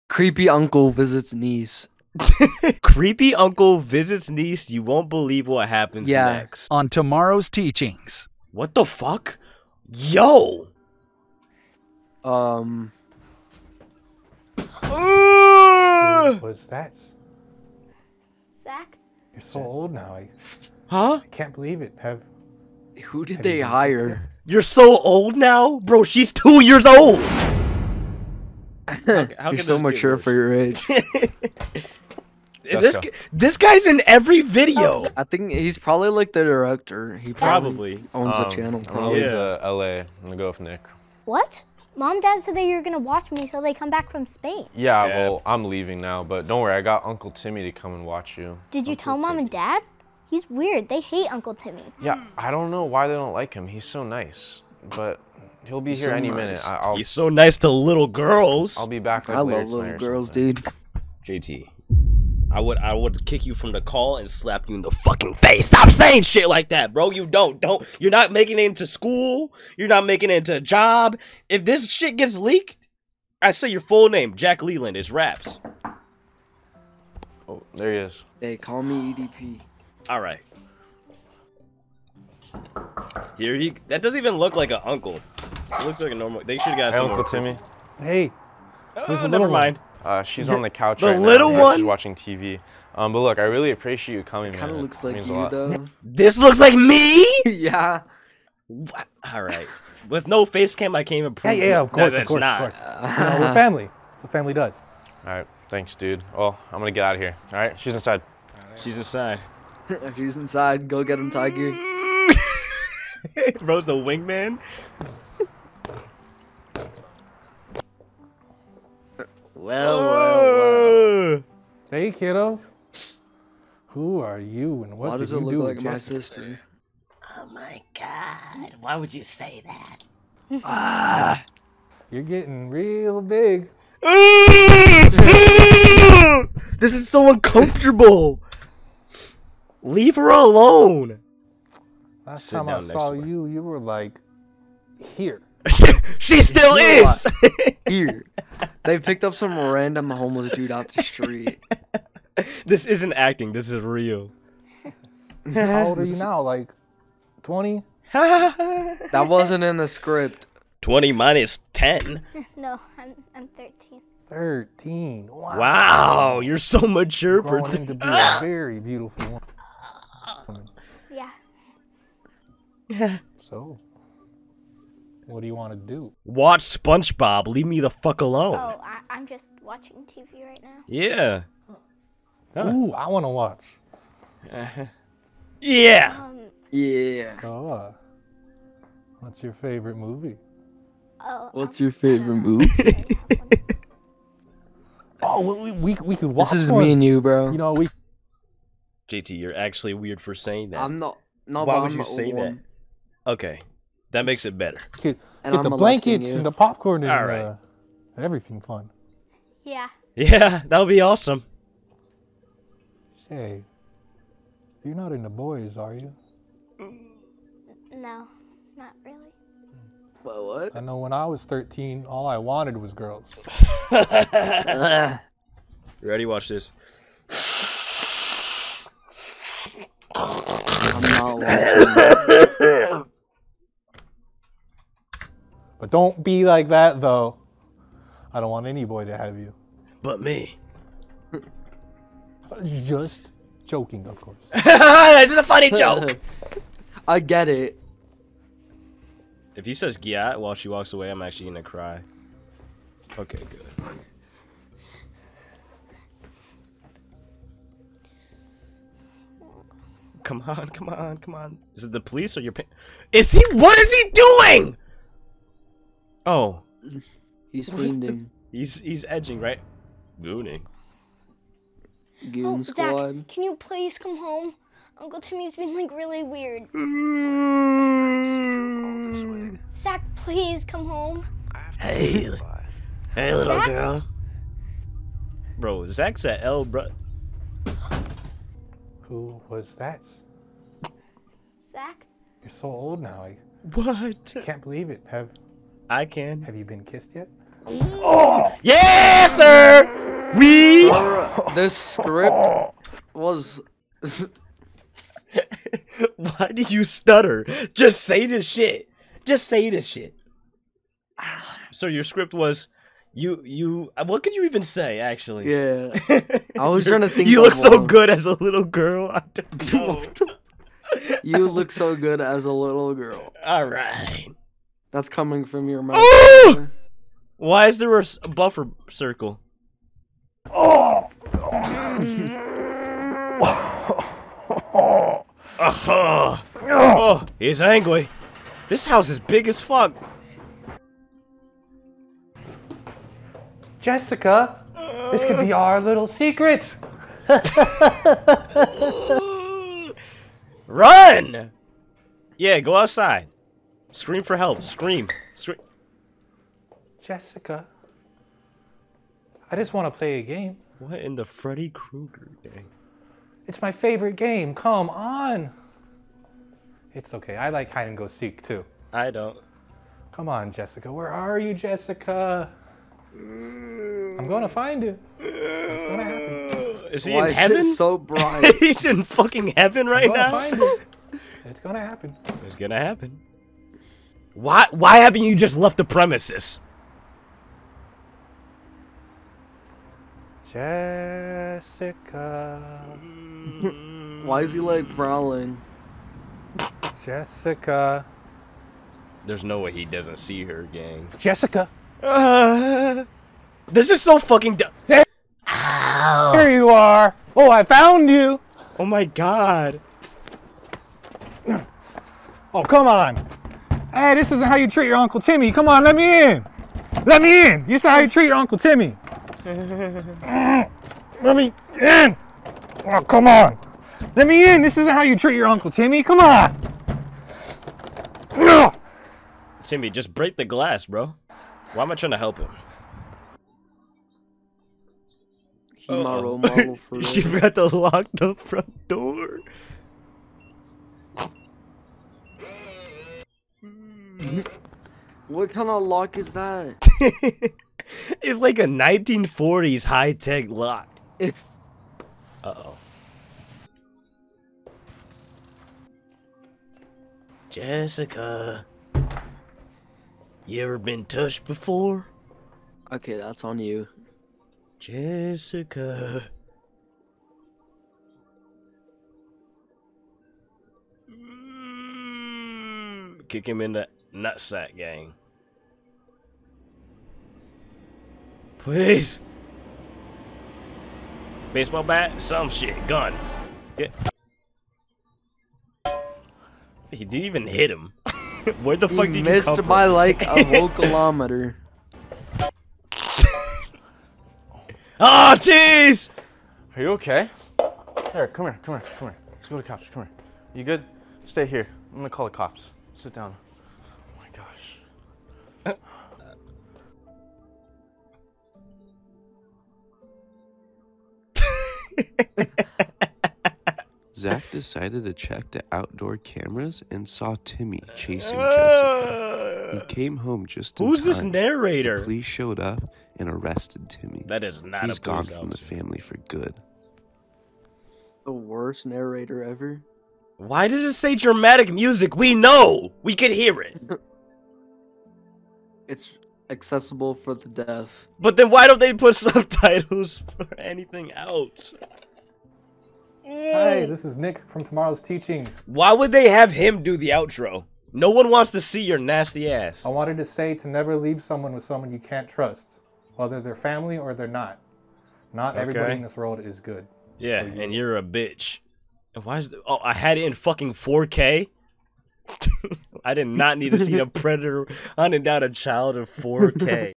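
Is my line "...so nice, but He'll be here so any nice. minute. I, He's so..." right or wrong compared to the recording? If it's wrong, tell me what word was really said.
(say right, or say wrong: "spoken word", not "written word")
right.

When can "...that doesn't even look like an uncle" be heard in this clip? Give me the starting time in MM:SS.
01:23.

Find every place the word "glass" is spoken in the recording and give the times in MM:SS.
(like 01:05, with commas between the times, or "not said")
07:10.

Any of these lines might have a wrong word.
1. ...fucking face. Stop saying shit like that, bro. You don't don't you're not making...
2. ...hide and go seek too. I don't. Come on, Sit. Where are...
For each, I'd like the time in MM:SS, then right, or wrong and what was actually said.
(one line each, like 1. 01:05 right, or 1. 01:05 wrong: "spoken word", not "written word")
1. 01:04 right
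2. 06:07 wrong: "Jessica", not "Sit".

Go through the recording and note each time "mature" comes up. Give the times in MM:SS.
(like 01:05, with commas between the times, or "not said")
00:29, 02:46.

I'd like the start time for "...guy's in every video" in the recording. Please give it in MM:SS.
00:33.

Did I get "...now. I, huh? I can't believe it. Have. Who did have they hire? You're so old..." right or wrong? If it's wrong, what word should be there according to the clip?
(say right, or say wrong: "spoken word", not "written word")
right.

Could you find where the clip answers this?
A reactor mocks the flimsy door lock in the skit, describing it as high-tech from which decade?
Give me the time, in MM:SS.
07:28.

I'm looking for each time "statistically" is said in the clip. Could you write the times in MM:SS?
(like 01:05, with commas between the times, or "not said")
not said.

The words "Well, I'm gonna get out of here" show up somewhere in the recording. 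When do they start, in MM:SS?
01:46.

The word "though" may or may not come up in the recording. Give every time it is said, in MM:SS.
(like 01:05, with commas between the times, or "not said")
01:35, 03:57.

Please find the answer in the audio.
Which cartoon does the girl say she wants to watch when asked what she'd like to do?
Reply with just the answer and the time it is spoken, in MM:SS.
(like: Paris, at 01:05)
SpongeBob, at 02:56.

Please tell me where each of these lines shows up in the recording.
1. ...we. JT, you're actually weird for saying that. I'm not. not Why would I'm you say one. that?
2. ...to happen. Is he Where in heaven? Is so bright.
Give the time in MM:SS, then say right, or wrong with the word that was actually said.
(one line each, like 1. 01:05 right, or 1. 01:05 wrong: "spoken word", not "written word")
1. 03:17 right
2. 06:15 wrong: "Why", not "Where".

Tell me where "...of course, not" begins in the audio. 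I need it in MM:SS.
01:42.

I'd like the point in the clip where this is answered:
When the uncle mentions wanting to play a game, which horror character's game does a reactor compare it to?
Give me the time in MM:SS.
06:01.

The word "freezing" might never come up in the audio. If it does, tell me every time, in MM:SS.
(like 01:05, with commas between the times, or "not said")
not said.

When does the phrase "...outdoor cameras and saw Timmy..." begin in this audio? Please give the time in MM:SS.
08:35.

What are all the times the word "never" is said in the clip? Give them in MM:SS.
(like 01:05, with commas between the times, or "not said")
01:29, 09:10.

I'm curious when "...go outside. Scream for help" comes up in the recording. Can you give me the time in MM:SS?
05:52.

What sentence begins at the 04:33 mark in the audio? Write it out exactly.
Zach, can you please come home?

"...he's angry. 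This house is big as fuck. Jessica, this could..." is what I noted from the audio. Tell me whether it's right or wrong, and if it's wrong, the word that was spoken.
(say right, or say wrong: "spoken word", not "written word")
right.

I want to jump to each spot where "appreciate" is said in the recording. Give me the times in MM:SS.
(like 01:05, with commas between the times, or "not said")
01:33.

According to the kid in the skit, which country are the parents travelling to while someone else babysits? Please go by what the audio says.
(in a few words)
Spain.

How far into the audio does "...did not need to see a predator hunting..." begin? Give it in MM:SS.
09:23.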